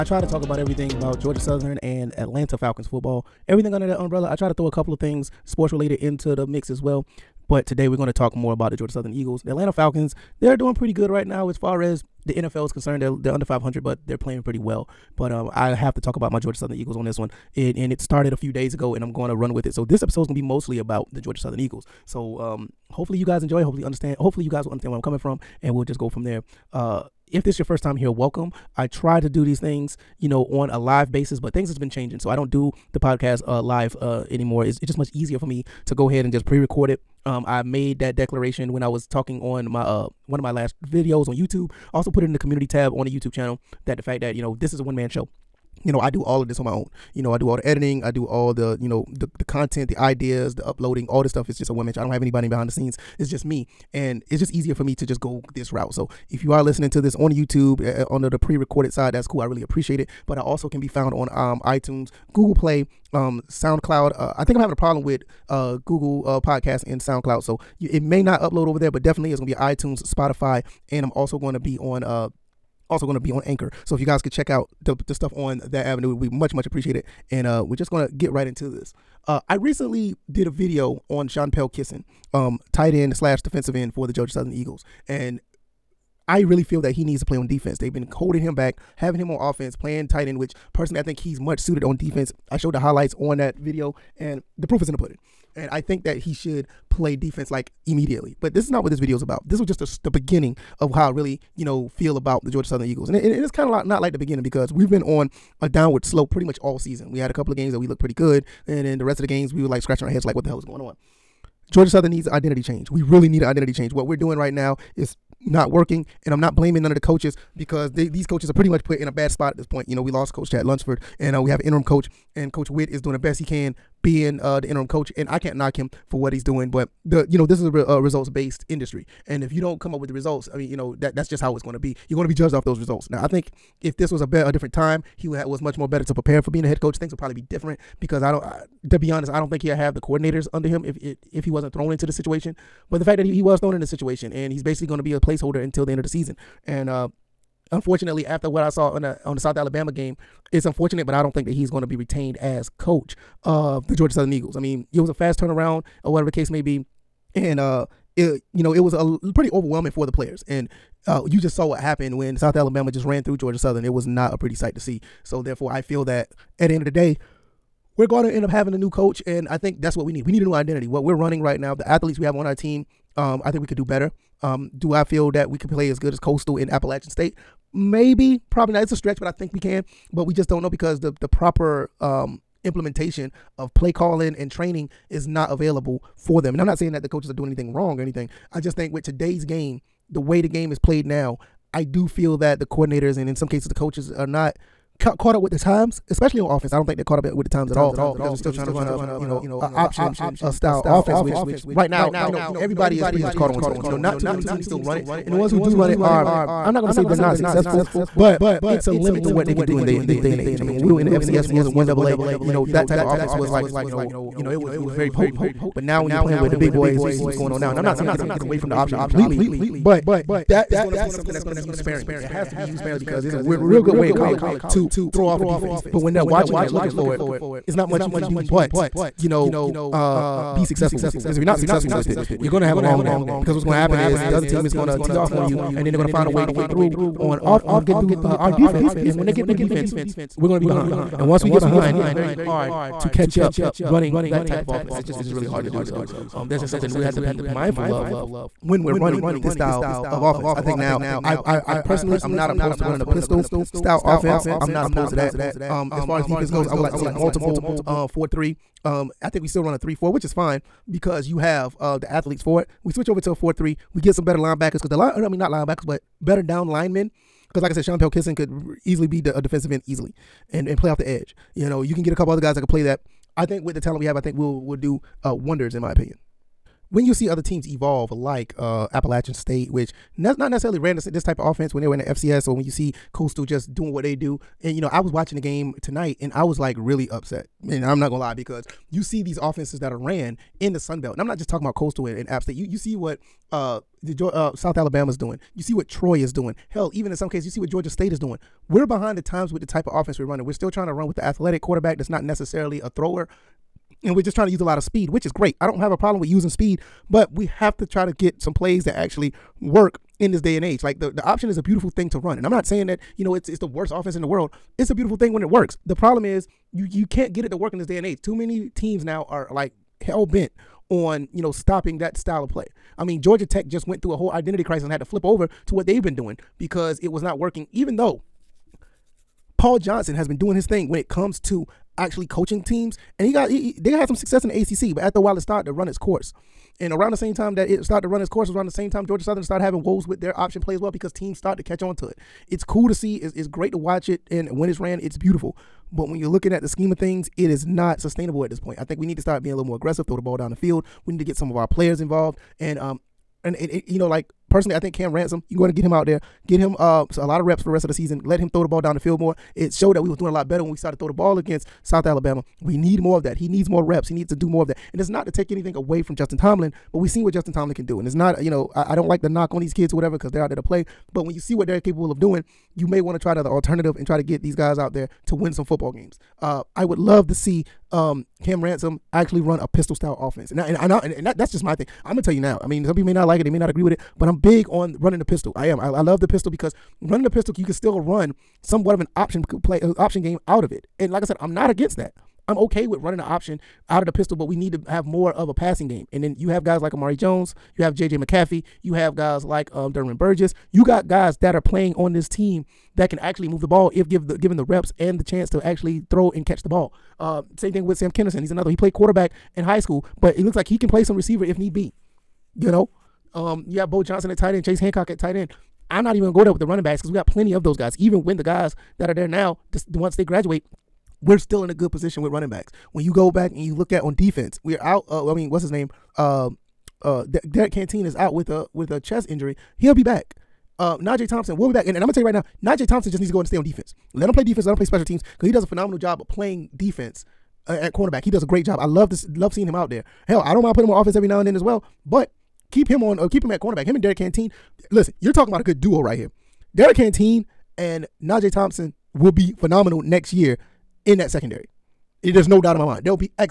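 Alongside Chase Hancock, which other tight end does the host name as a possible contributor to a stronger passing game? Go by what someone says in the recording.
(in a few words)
Bo Johnson.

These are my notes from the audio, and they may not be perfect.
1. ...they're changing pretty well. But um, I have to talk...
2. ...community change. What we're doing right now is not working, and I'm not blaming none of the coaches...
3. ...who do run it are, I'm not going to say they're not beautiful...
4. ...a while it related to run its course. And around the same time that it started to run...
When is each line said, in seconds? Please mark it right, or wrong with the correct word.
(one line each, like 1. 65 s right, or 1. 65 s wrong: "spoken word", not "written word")
1. 14 s wrong: "playing", not "changing"
2. 113 s wrong: "identity", not "community"
3. 205 s wrong: "successful", not "beautiful"
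4. 335 s wrong: "started", not "related".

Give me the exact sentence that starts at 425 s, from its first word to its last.
Uh, I mean, what's his name?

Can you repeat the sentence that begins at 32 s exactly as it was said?
So I don't do the podcast uh, live uh, anymore.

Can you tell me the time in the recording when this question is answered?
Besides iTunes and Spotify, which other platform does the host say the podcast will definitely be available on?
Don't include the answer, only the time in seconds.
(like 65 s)
73 s.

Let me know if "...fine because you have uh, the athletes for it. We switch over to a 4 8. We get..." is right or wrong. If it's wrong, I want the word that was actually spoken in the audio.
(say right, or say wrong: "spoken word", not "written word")
wrong: "3", not "8".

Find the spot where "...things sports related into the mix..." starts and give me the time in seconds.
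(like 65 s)
4 s.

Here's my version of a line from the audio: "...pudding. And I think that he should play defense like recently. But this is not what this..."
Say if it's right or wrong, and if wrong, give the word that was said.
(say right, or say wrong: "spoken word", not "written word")
wrong: "immediately", not "recently".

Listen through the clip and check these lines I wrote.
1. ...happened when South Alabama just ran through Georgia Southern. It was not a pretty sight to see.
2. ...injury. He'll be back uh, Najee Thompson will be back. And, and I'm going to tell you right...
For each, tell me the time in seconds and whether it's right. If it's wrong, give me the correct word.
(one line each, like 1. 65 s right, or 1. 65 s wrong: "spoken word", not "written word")
1. 161 s right
2. 429 s right.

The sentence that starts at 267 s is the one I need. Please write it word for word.
Because, like I said, Sean Pelkisson could easily be the, a defensive end easily and, and play off the edge.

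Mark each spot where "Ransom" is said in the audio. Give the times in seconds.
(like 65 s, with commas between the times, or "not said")
355 s, 378 s.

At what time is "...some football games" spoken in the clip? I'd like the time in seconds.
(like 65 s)
375 s.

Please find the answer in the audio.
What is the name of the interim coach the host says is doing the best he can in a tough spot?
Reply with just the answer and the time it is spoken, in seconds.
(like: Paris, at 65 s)
Coach Witt, at 122 s.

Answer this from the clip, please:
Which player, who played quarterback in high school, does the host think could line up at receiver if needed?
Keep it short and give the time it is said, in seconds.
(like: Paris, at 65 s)
Sam Kenerson, at 407 s.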